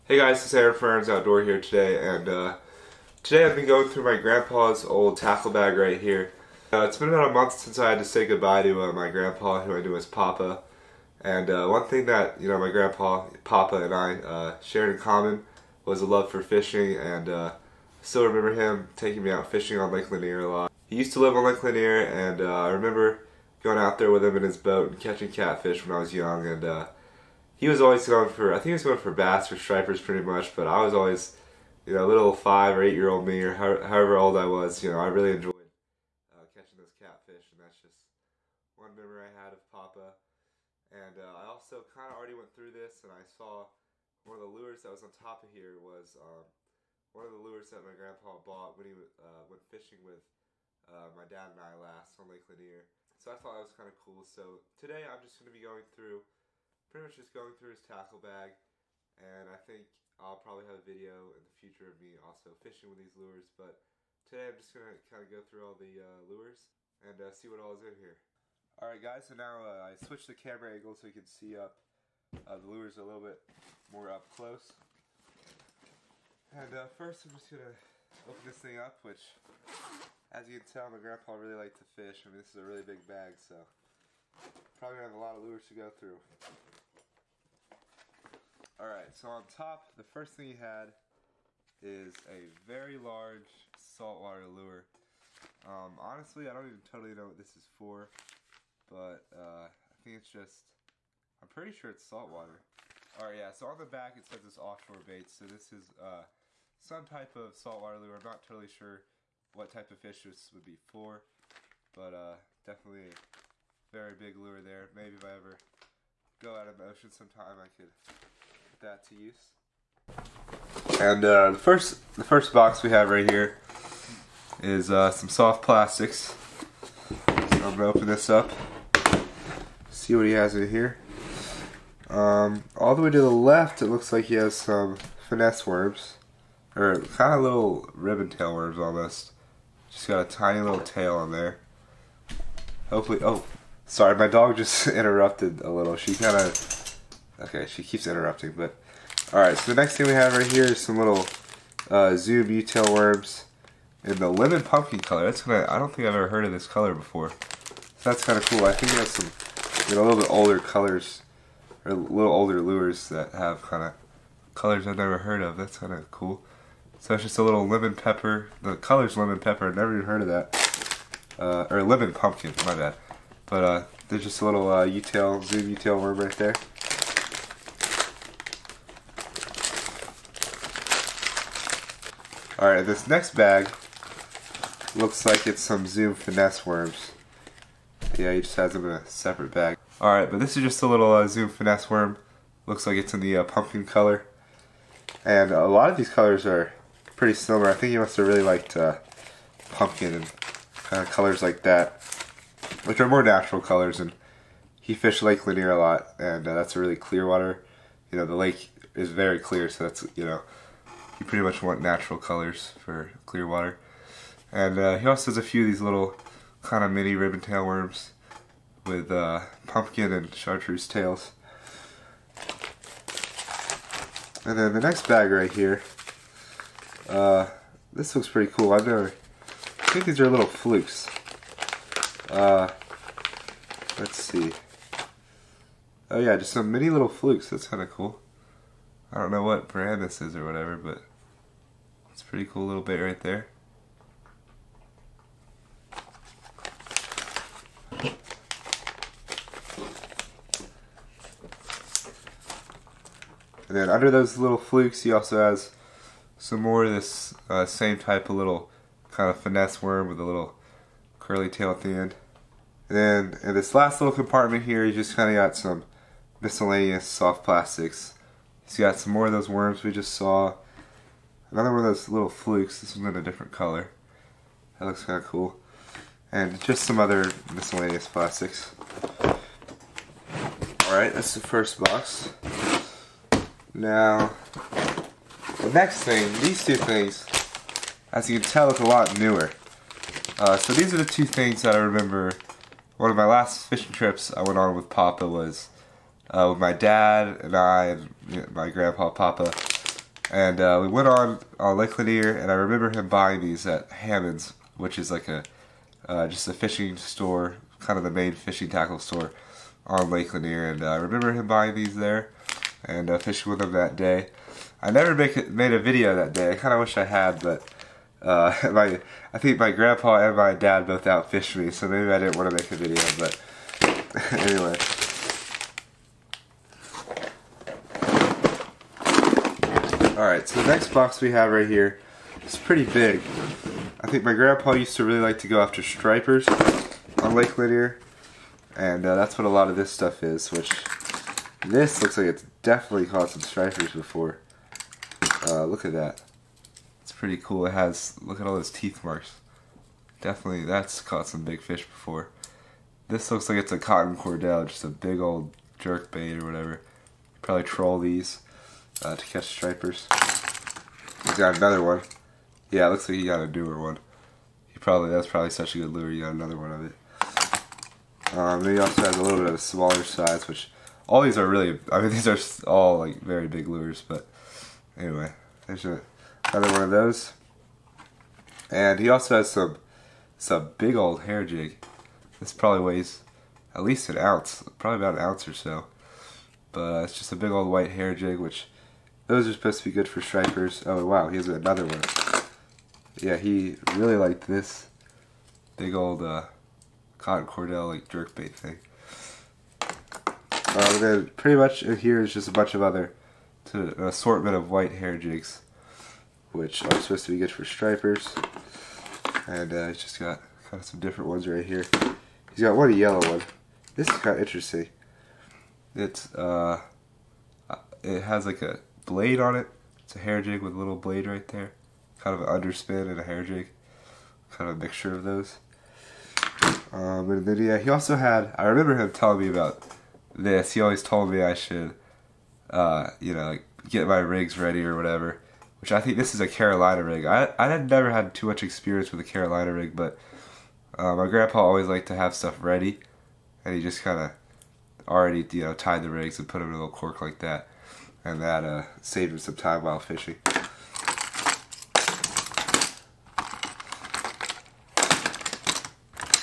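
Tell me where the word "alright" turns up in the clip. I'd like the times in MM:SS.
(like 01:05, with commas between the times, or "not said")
01:08, 02:29, 03:02, 03:09, 04:40, 05:30.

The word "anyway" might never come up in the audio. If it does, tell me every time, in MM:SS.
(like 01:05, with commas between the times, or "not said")
05:24, 06:14.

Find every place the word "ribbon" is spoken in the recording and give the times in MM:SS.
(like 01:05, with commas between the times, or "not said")
02:17, 03:37.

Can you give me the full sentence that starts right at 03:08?
Yeah, he just has them in a separate bag.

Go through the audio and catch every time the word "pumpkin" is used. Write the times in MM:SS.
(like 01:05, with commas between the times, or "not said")
02:34, 02:52, 03:13, 03:19, 03:39.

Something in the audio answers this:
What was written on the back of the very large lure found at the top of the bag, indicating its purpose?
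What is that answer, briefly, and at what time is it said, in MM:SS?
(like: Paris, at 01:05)
offshore bait, at 01:44.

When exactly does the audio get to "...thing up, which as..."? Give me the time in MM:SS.
01:18.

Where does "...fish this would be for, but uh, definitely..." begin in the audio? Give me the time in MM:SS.
01:50.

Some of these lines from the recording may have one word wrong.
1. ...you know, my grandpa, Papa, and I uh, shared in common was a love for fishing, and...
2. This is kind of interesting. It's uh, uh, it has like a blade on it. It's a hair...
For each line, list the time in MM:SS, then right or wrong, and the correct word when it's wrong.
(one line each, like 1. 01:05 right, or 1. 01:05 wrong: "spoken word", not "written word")
1. 00:12 right
2. 06:53 right.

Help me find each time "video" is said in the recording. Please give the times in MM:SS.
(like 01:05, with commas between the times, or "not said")
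01:00, 05:15, 05:22.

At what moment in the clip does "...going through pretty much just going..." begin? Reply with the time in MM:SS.
00:55.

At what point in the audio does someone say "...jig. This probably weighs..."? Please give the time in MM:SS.
06:21.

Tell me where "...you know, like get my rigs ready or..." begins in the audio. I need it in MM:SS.
07:13.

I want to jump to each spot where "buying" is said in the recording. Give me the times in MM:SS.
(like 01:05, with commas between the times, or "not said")
05:03, 05:11.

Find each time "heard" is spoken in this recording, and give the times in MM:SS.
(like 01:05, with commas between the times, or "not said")
02:36, 02:45, 02:50.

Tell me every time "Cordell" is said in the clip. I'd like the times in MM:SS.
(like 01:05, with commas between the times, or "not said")
05:54, 06:37.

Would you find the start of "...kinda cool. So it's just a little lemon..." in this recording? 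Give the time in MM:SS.
02:45.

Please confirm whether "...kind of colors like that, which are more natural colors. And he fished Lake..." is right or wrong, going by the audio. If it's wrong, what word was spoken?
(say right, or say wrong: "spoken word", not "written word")
right.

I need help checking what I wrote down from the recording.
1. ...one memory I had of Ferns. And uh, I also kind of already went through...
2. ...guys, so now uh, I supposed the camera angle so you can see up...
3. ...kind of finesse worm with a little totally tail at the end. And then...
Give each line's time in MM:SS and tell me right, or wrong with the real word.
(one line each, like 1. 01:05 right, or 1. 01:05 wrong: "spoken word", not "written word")
1. 00:38 wrong: "Papa", not "Ferns"
2. 01:09 wrong: "switched", not "supposed"
3. 04:19 wrong: "curly", not "totally".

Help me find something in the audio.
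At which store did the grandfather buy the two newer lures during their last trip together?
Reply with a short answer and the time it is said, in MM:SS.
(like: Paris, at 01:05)
Hammond's, at 05:03.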